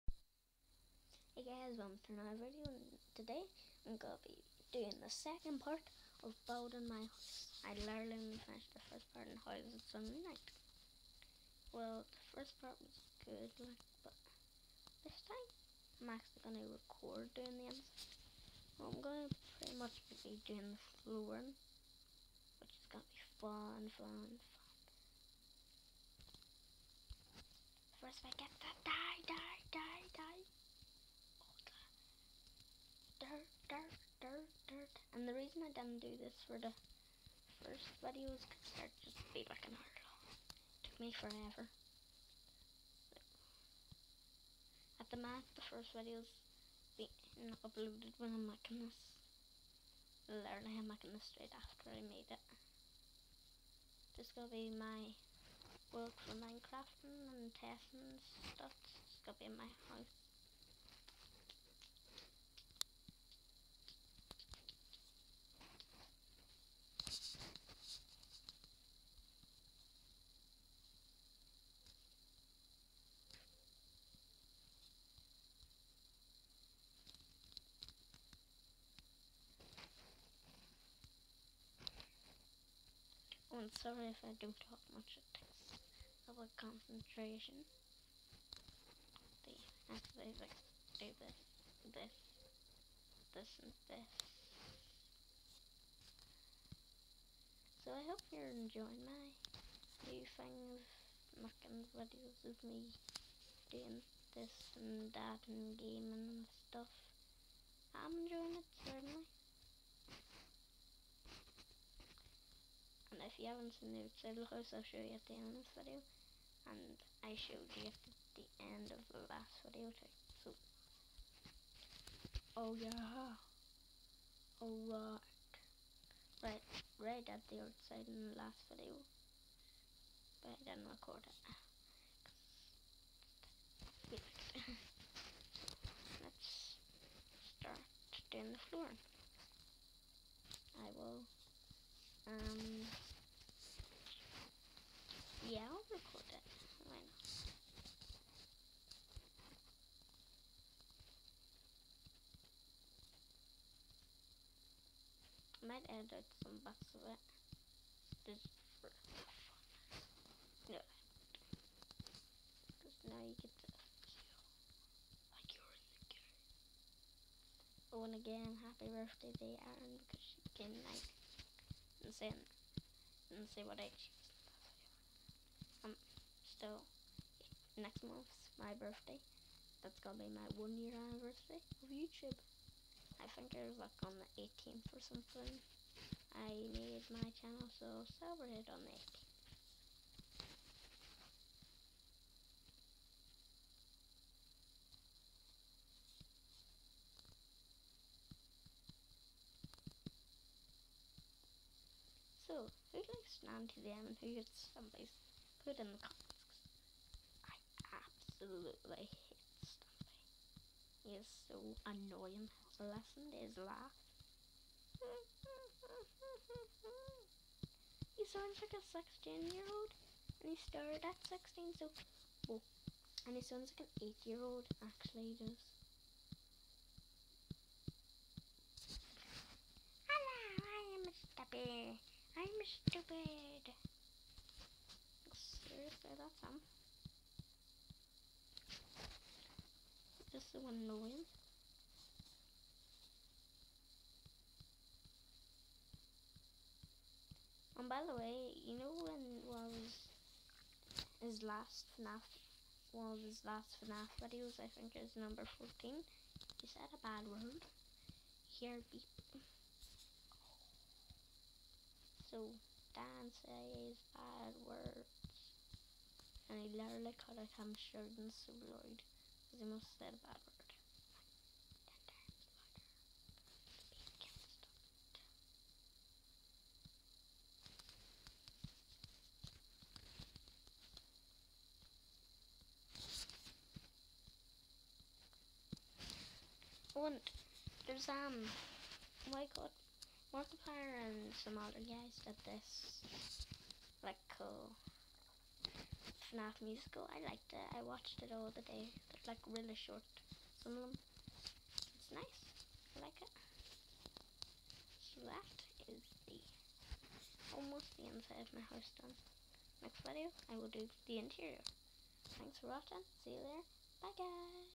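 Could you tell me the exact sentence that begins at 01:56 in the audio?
And I showed you at the end of the last video too.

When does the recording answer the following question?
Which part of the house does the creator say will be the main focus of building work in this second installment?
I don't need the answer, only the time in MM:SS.
00:21.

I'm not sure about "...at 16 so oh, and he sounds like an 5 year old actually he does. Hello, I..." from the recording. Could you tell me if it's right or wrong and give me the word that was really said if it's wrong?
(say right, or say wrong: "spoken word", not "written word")
wrong: "8", not "5".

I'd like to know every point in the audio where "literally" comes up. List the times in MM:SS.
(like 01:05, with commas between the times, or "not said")
00:07, 00:50, 04:26.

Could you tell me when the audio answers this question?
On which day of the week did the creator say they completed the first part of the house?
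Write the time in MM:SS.
00:09.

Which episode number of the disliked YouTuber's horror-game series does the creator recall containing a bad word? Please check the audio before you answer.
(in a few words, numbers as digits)
14.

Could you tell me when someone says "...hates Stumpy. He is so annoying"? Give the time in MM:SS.
03:28.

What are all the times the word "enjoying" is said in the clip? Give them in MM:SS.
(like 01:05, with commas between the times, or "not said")
01:38, 01:48.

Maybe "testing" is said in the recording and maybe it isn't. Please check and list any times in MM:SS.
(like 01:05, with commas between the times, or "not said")
00:57.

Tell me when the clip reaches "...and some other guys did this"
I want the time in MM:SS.
04:51.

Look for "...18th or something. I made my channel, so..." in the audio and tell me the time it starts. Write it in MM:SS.
03:04.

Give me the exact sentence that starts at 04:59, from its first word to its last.
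They're like really short, some of them.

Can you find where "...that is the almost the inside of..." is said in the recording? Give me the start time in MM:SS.
05:05.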